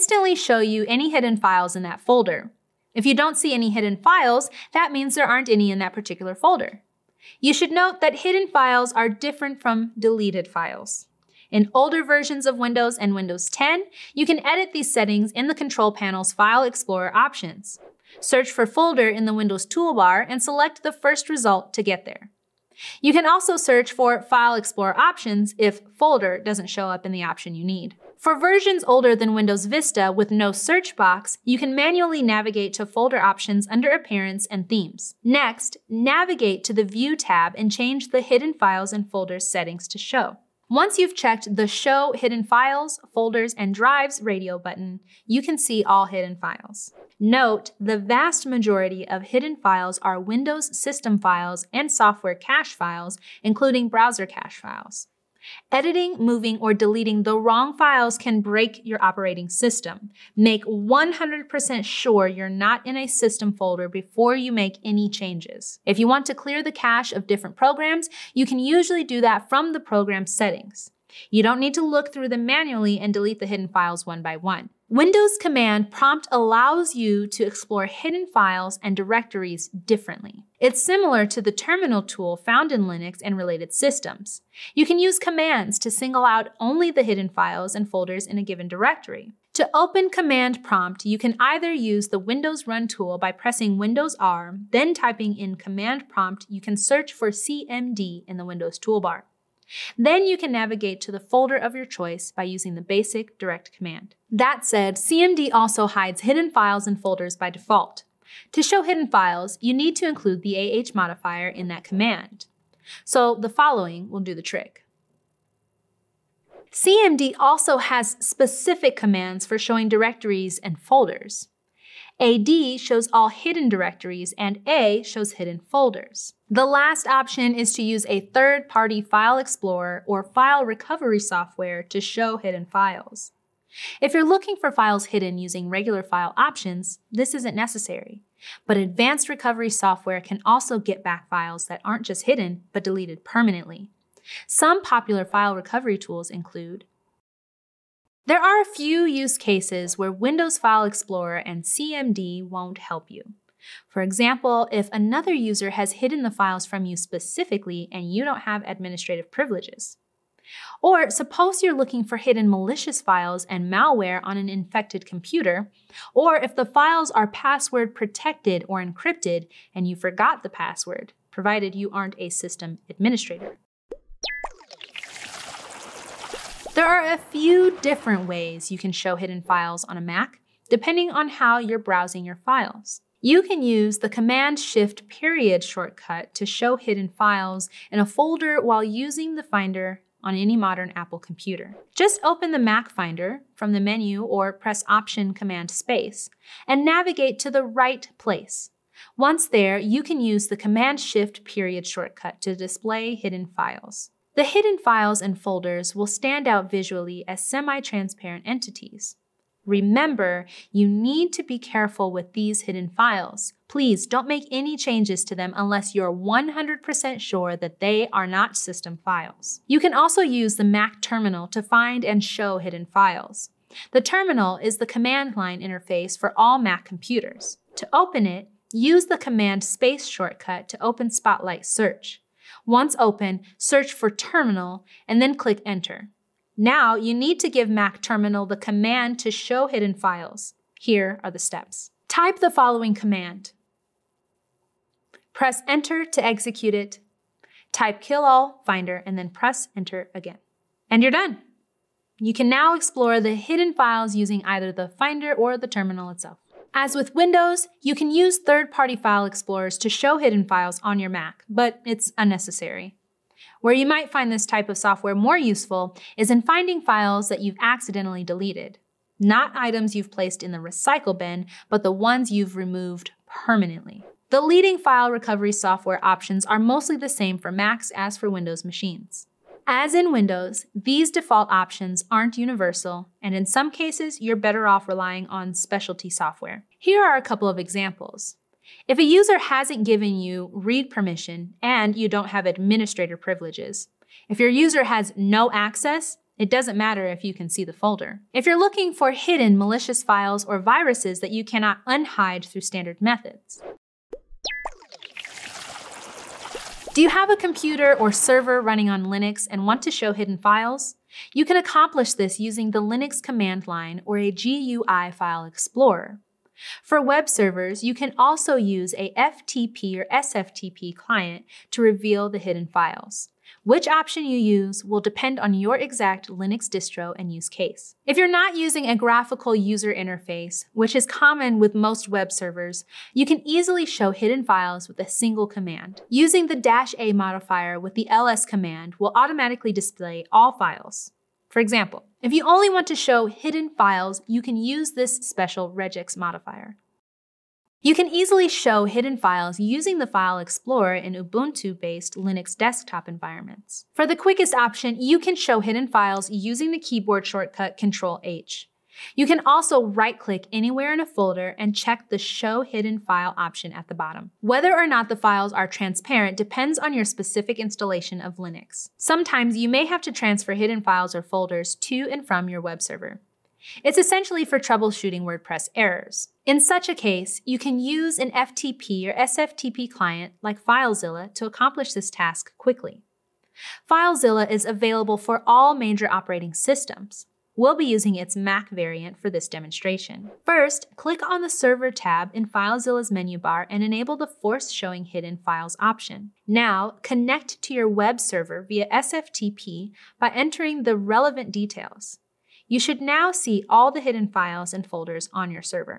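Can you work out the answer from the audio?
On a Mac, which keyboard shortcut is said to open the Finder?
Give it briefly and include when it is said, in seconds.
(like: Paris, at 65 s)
Option Command Space, at 194 s.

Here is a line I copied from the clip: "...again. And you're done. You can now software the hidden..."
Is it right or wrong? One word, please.
wrong.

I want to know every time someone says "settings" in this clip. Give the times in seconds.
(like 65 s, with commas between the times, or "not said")
14 s, 39 s, 70 s.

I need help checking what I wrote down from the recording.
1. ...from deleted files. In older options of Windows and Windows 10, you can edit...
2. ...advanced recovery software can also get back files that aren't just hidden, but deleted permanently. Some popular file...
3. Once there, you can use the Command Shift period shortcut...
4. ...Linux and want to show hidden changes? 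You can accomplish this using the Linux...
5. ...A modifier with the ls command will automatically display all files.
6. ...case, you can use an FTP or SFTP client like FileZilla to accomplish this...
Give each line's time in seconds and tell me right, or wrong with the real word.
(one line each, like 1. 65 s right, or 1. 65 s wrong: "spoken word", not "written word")
1. 9 s wrong: "versions", not "options"
2. 138 s right
3. 199 s right
4. 309 s wrong: "files", not "changes"
5. 336 s right
6. 376 s right.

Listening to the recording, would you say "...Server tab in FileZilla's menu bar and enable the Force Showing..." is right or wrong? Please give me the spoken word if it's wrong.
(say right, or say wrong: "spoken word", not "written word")
right.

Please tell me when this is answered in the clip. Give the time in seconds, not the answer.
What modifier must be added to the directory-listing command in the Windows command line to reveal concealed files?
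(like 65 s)
110 s.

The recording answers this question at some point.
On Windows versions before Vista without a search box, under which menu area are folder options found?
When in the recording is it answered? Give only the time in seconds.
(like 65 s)
33 s.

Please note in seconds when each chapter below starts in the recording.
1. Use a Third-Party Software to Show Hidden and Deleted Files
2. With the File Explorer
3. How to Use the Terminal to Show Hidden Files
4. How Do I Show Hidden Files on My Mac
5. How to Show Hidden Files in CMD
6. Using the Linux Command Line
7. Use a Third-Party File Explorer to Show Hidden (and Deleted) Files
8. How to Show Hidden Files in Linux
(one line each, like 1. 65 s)
1. 130 s
2. 352 s
3. 221 s
4. 176 s
5. 78 s
6. 329 s
7. 258 s
8. 306 s.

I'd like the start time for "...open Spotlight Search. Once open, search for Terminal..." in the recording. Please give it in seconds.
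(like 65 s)
230 s.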